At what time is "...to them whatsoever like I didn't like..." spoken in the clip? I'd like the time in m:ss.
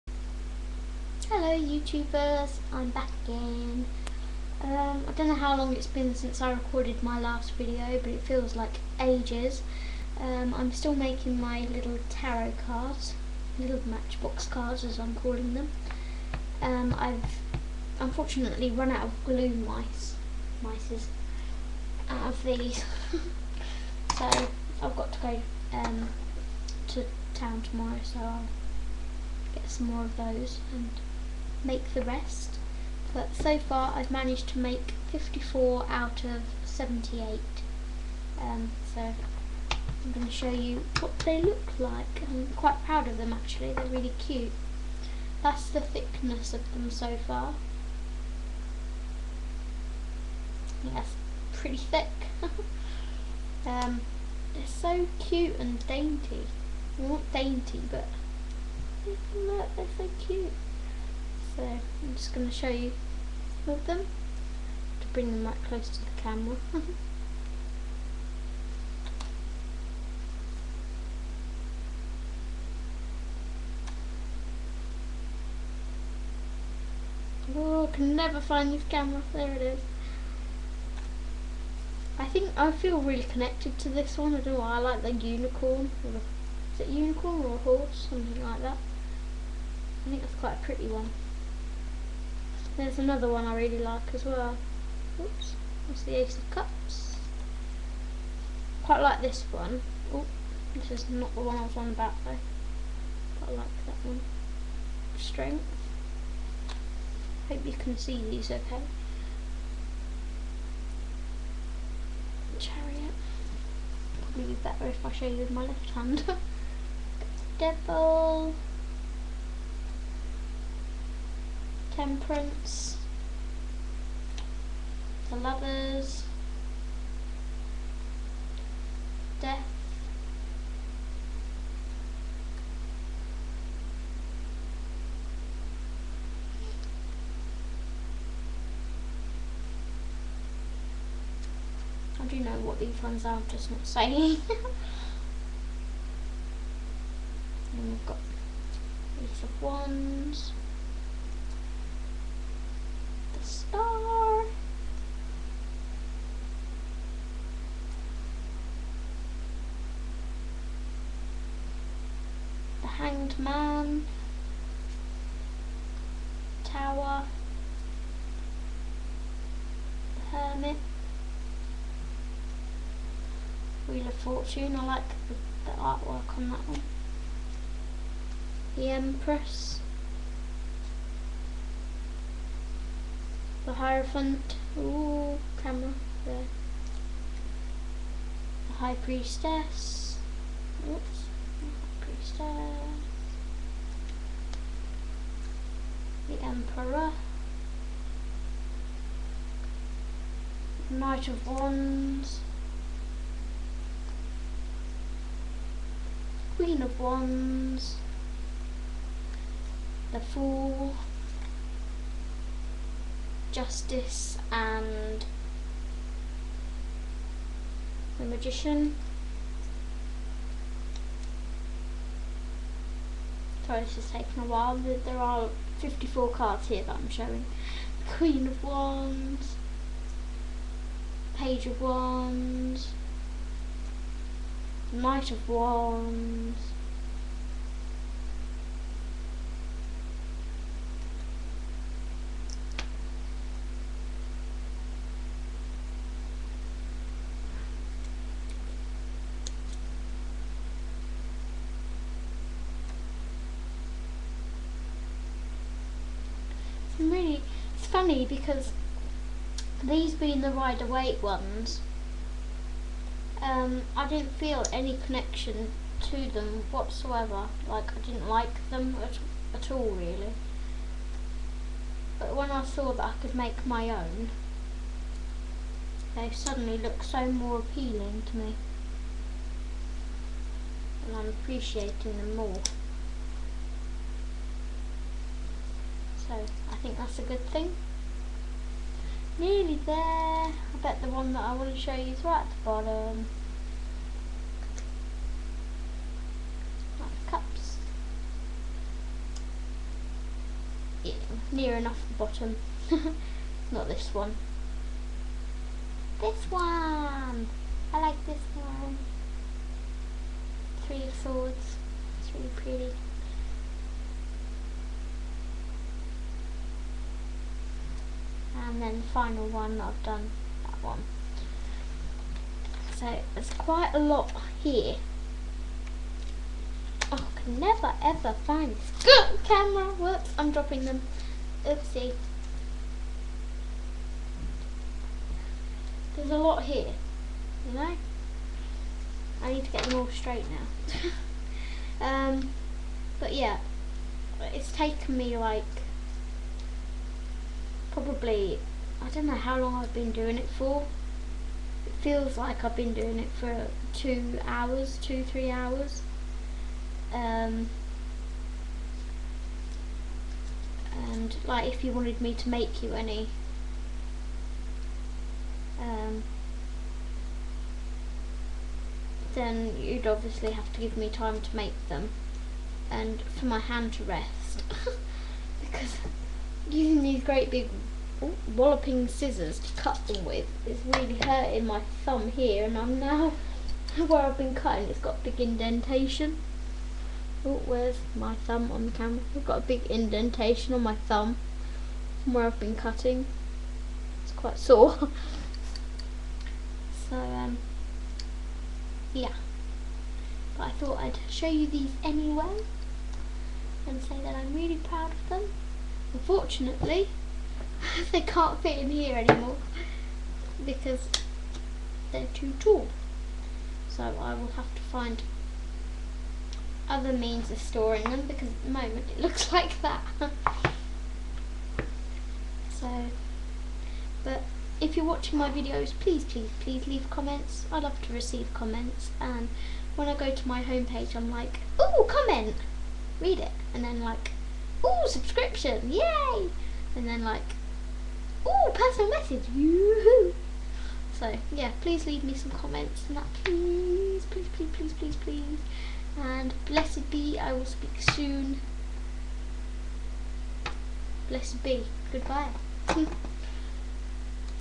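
4:26.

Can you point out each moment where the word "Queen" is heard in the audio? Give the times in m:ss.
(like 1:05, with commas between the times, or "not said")
3:26, 3:48.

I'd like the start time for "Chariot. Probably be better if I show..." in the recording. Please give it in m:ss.
1:52.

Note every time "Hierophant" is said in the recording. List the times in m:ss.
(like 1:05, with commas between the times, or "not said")
3:03.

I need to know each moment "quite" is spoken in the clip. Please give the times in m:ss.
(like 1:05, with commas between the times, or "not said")
0:42, 1:30, 1:38, 1:43, 5:23, 6:34.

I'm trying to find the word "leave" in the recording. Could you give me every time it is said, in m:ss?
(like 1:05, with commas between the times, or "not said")
7:06, 7:22.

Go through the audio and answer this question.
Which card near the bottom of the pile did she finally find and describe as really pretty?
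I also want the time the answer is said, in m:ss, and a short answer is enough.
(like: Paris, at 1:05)
Three swords, at 5:10.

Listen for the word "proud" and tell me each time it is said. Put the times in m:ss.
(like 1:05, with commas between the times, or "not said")
0:42, 6:44.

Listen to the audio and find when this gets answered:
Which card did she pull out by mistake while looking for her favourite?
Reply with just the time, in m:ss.
1:36.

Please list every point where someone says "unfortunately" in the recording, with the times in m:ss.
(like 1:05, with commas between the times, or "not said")
0:17, 6:46.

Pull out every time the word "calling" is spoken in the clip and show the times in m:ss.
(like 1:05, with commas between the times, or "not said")
0:15.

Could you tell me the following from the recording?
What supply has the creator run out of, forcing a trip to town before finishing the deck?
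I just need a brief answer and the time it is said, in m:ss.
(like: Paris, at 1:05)
glue, at 0:19.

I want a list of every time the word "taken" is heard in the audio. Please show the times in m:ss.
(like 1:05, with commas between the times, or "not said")
3:44, 5:44.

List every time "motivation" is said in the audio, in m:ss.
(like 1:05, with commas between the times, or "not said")
not said.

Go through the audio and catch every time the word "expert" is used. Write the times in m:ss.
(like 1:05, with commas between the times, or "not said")
not said.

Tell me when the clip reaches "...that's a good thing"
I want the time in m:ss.
4:46.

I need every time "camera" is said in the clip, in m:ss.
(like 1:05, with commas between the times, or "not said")
1:06, 1:18, 3:05, 5:29, 6:28.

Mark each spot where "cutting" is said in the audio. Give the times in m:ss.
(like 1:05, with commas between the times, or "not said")
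6:24, 6:32.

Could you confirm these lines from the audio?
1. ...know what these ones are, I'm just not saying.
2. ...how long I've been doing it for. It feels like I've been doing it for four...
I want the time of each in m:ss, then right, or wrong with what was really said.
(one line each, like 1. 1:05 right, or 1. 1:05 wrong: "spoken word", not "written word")
1. 2:22 right
2. 5:49 wrong: "two", not "four".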